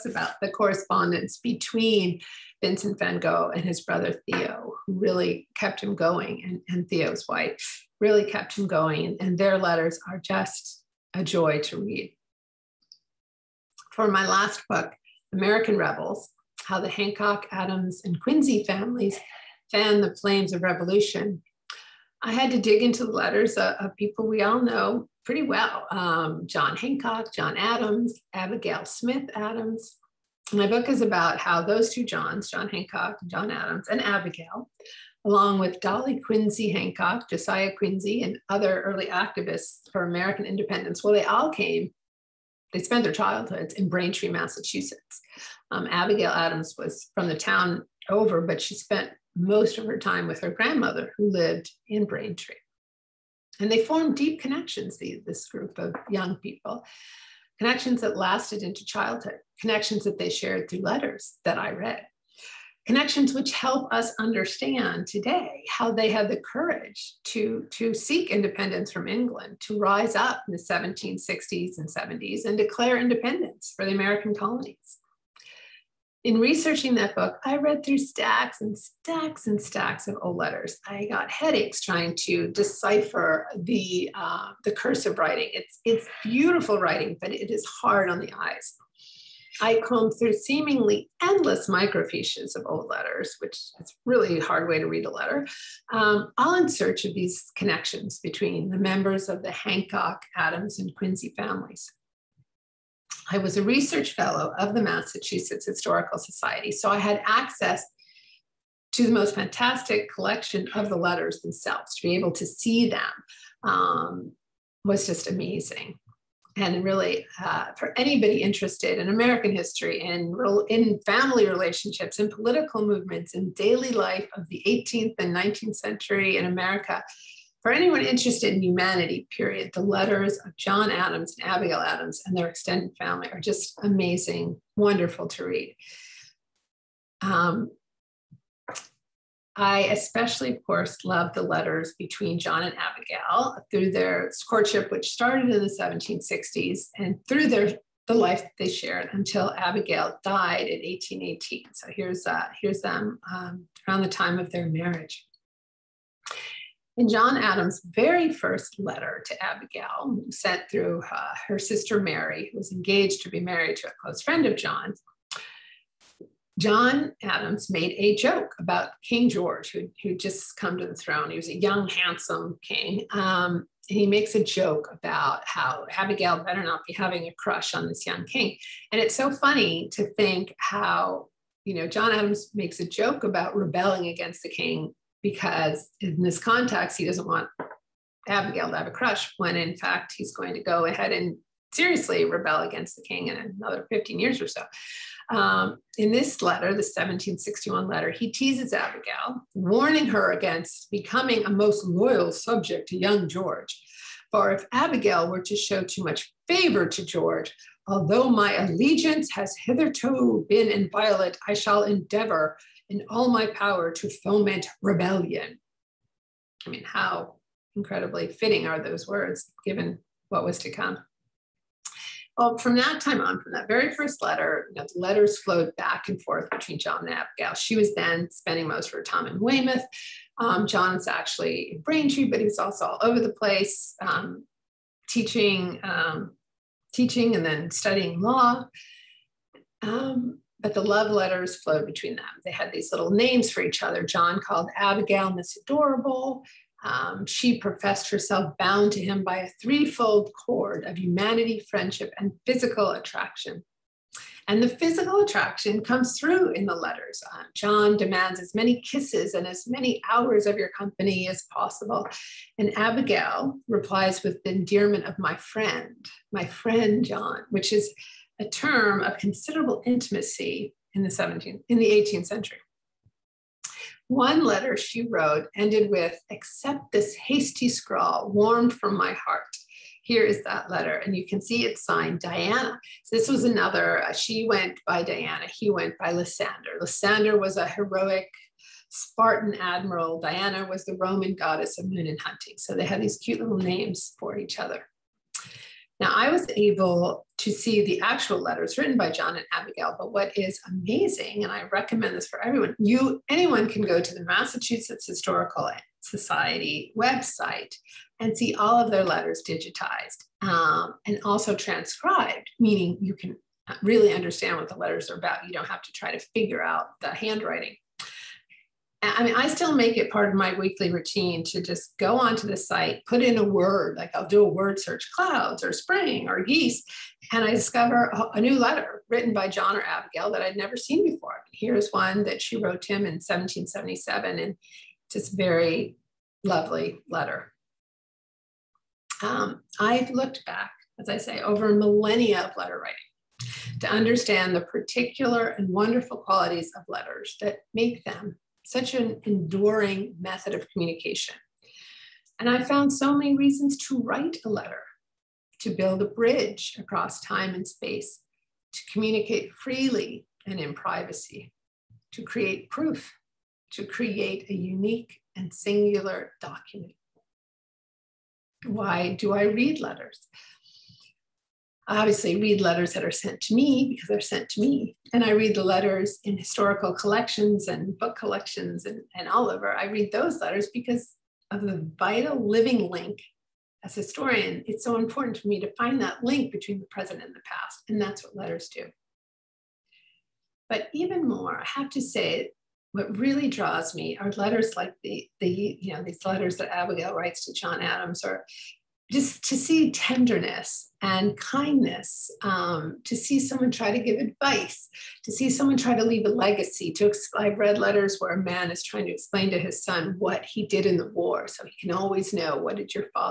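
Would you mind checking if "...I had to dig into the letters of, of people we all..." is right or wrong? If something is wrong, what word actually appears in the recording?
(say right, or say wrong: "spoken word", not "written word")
right.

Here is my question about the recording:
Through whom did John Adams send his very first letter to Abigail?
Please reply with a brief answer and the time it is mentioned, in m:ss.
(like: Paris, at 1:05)
Mary, at 2:41.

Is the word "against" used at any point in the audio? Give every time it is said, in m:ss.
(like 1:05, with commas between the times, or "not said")
3:04, 3:12, 3:20.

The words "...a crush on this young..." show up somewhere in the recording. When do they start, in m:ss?
2:57.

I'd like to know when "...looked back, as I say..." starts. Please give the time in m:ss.
5:40.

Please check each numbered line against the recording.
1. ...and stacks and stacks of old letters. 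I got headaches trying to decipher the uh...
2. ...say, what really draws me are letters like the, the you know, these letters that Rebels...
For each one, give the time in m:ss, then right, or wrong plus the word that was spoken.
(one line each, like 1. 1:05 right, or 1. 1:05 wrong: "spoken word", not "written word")
1. 1:18 right
2. 6:32 wrong: "Abigail", not "Rebels".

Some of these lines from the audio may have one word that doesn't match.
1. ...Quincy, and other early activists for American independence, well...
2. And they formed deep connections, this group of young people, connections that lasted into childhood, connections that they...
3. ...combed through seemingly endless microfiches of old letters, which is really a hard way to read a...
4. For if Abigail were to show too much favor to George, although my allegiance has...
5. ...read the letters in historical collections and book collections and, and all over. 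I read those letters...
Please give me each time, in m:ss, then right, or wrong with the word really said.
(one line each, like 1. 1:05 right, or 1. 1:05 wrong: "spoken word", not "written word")
1. 0:37 right
2. 0:53 right
3. 1:29 right
4. 3:24 right
5. 6:15 right.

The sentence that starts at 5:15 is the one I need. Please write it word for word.
You don't have to try to figure out the handwriting.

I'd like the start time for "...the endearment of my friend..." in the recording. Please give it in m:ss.
4:24.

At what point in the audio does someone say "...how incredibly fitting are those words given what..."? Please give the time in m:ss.
3:36.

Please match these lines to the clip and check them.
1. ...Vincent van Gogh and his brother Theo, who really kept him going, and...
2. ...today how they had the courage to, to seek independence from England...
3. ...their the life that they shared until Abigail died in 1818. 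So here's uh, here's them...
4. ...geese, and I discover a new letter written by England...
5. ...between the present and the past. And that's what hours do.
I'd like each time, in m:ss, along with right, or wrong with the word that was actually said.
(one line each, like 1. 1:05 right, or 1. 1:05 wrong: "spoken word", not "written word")
1. 0:02 right
2. 1:05 right
3. 2:27 right
4. 5:26 wrong: "John", not "England"
5. 6:26 wrong: "letters", not "hours".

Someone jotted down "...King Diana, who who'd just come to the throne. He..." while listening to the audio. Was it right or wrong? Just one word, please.
wrong.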